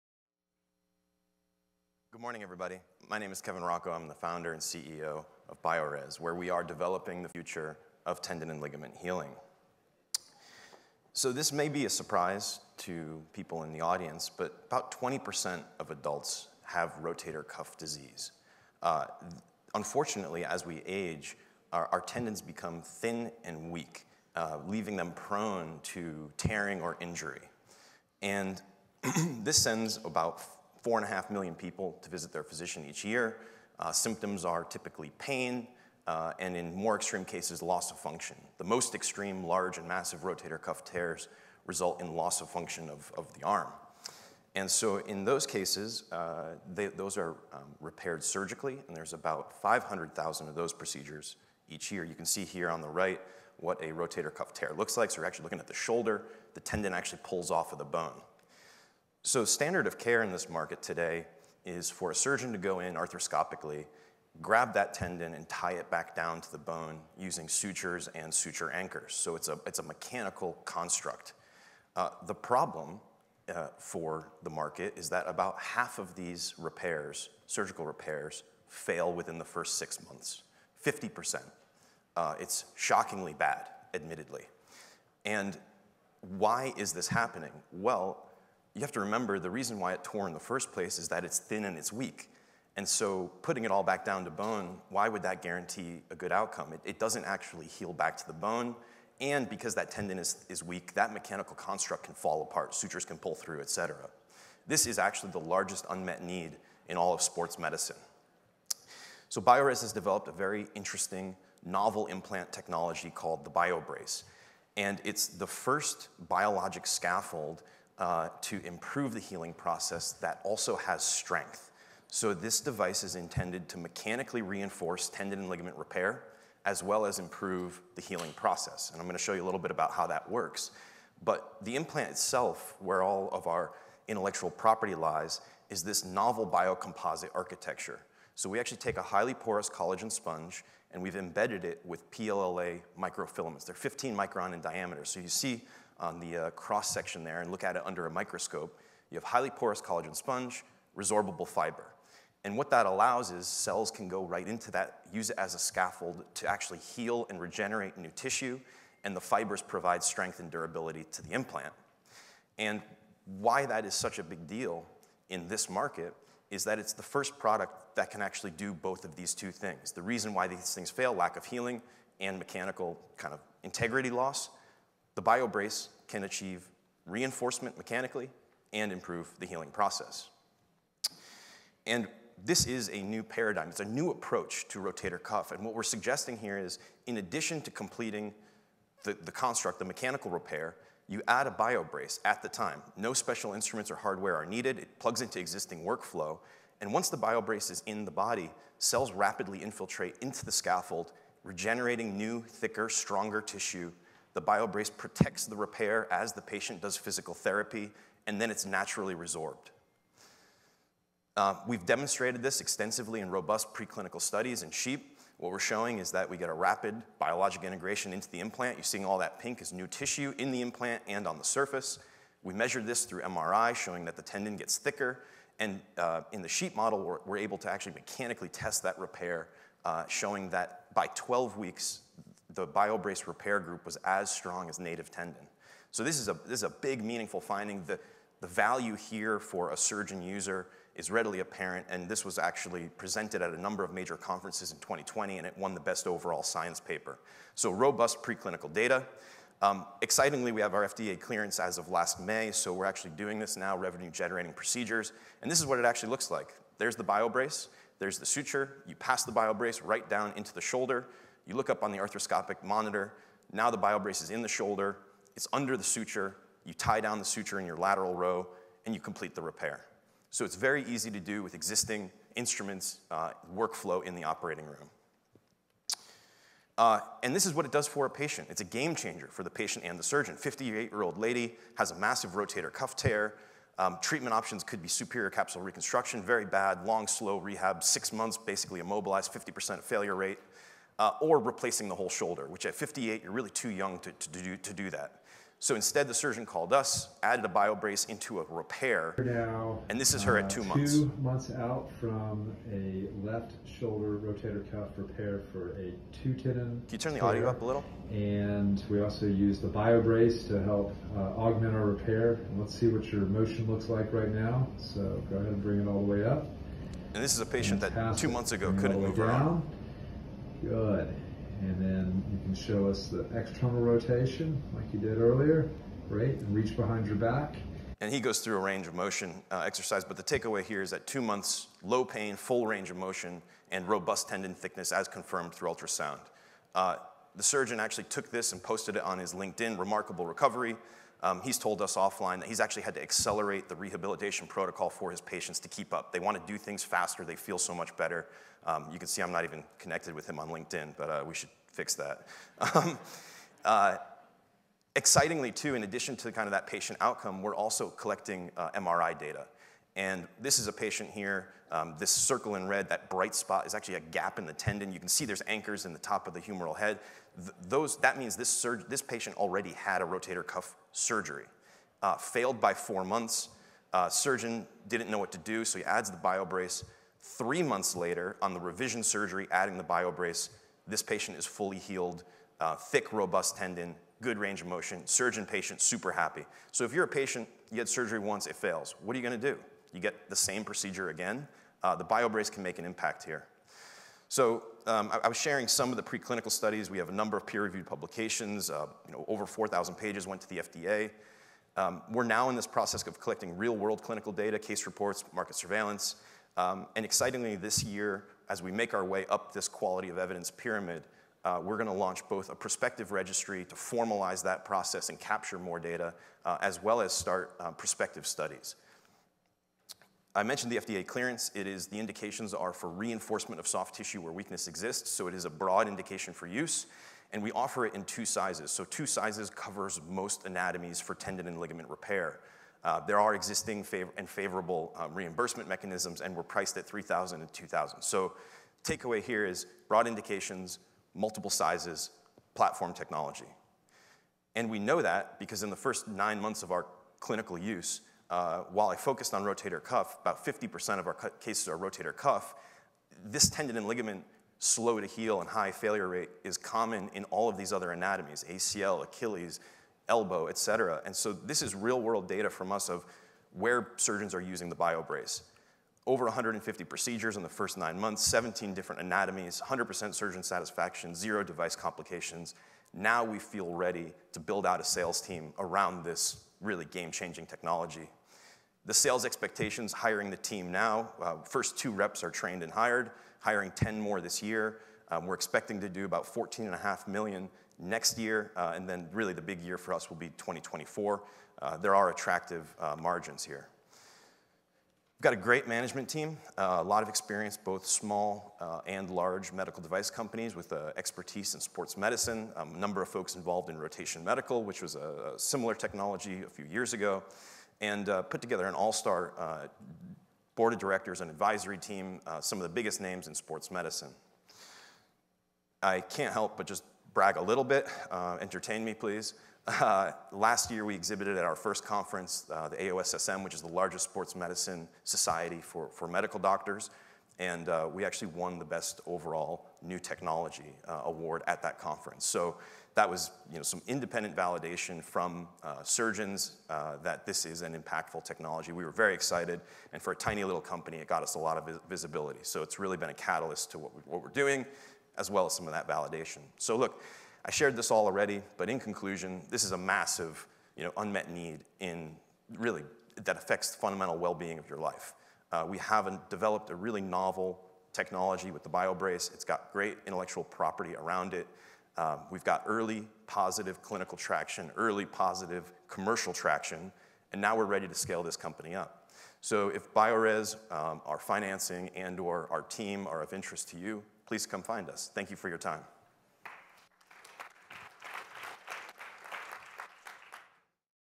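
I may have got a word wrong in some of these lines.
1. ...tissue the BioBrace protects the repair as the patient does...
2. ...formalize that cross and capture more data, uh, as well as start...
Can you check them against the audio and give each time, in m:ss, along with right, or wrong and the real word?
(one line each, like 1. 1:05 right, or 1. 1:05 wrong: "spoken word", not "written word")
1. 3:23 right
2. 6:53 wrong: "process", not "cross".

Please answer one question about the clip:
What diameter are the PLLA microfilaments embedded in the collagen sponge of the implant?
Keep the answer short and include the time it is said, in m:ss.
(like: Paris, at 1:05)
15 microns, at 2:23.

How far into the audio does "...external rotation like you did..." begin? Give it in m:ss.
5:23.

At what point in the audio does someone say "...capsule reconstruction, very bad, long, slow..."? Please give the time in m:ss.
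4:45.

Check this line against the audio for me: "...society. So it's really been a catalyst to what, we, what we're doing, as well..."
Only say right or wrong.
wrong.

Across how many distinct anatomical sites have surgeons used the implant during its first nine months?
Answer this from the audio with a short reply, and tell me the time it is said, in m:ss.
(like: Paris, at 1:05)
17, at 7:48.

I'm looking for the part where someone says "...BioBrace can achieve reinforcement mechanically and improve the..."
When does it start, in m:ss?
2:55.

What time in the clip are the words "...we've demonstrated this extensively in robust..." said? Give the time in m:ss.
3:31.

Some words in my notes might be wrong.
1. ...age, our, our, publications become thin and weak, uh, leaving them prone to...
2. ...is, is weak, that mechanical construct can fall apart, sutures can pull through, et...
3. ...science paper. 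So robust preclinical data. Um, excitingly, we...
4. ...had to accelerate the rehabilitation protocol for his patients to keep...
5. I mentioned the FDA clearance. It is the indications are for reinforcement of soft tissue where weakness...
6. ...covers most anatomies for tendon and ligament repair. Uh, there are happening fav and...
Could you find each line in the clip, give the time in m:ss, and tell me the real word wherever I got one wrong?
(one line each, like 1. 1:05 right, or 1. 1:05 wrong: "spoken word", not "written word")
1. 0:20 wrong: "tendons", not "publications"
2. 1:40 right
3. 4:06 right
4. 5:42 right
5. 7:00 right
6. 7:09 wrong: "existing", not "happening".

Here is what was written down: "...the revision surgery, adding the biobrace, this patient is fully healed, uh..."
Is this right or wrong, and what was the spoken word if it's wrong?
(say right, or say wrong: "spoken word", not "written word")
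right.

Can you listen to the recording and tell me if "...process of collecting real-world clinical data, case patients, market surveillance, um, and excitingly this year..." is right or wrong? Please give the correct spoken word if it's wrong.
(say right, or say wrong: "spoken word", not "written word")
wrong: "reports", not "patients".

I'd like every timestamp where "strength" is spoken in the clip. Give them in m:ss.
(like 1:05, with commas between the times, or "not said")
2:01, 2:40.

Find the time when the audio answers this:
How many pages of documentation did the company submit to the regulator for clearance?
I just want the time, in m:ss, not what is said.
6:39.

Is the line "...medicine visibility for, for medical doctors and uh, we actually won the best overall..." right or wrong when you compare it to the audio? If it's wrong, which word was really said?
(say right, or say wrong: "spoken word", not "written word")
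wrong: "society", not "visibility".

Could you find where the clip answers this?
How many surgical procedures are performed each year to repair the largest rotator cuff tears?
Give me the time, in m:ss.
0:49.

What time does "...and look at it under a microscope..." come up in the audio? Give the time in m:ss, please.
2:27.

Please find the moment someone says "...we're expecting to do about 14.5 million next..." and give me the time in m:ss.
8:05.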